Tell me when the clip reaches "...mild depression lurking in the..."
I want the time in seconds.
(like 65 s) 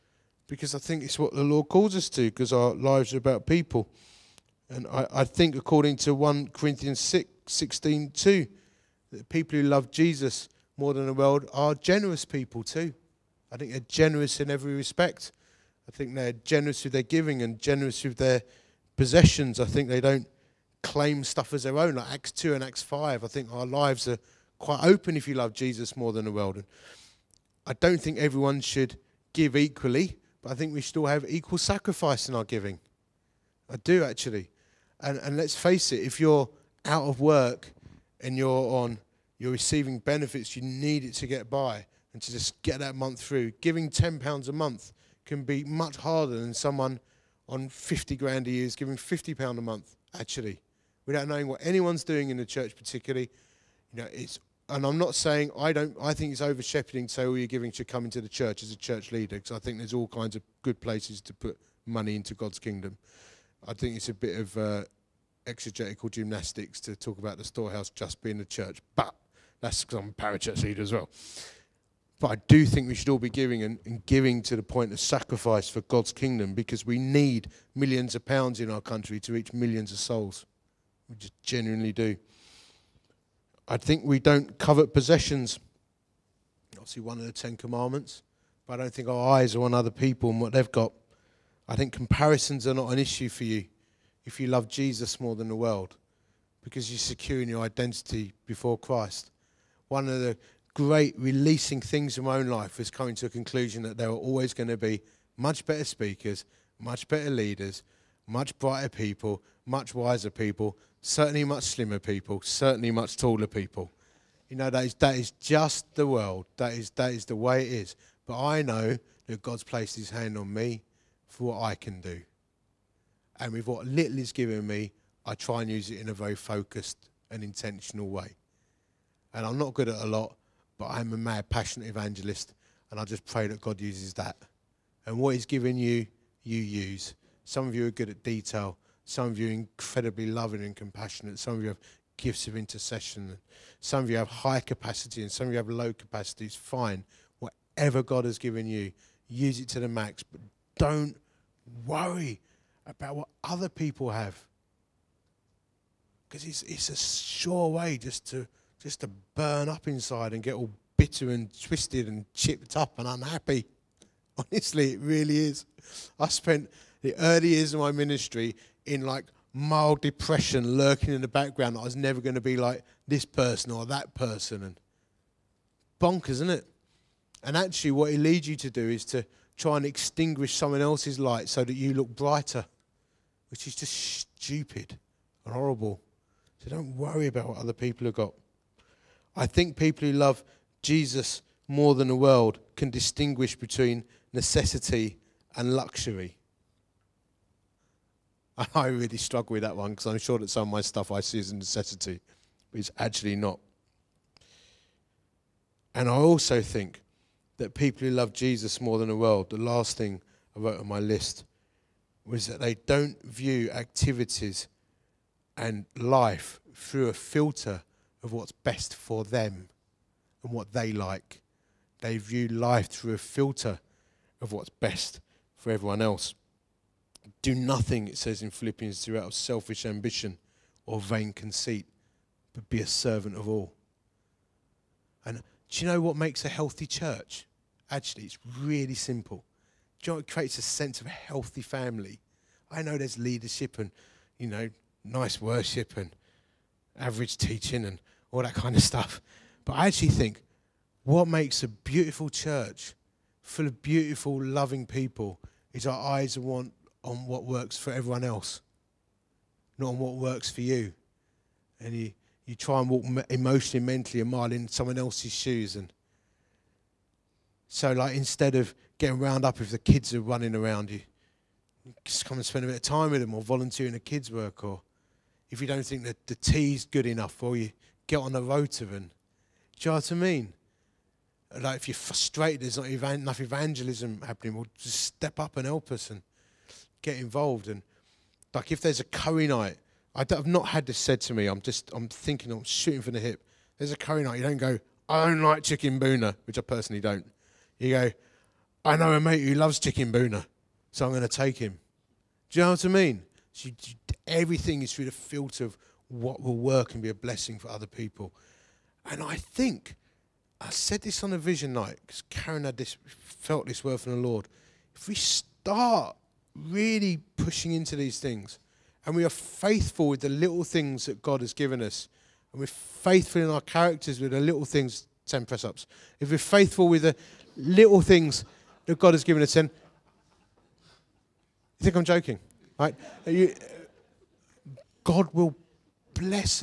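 169 s.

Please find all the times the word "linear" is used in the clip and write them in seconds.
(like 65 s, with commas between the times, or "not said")
not said.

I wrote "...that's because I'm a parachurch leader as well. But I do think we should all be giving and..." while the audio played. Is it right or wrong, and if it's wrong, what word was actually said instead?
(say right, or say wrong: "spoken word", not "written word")
right.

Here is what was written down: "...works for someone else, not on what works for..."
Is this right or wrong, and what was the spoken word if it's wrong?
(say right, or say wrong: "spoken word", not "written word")
wrong: "everyone", not "someone".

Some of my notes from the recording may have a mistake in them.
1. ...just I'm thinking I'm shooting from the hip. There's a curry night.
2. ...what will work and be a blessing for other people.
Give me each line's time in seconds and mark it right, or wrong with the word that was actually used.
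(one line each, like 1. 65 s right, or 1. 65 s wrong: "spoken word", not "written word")
1. 291 s right
2. 306 s right.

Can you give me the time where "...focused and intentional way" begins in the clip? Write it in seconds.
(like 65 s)
126 s.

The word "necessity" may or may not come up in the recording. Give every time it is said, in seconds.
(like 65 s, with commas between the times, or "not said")
194 s, 201 s.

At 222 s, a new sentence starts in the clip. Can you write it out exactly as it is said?
They view life through a filter of what's best for everyone else.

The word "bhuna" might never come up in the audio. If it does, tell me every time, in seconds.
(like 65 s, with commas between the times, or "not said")
295 s, 300 s.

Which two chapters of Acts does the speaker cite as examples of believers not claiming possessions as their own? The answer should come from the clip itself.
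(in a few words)
Acts 2 and Acts 5.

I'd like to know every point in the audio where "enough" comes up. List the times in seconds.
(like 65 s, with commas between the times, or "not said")
277 s, 283 s.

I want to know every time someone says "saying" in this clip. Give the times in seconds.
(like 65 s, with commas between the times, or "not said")
55 s.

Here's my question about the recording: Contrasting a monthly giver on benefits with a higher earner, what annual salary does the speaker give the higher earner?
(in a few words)
£50,000.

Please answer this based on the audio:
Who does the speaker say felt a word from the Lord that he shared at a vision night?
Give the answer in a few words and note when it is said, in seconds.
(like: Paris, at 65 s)
Karen, at 312 s.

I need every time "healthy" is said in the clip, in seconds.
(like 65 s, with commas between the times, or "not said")
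236 s, 241 s.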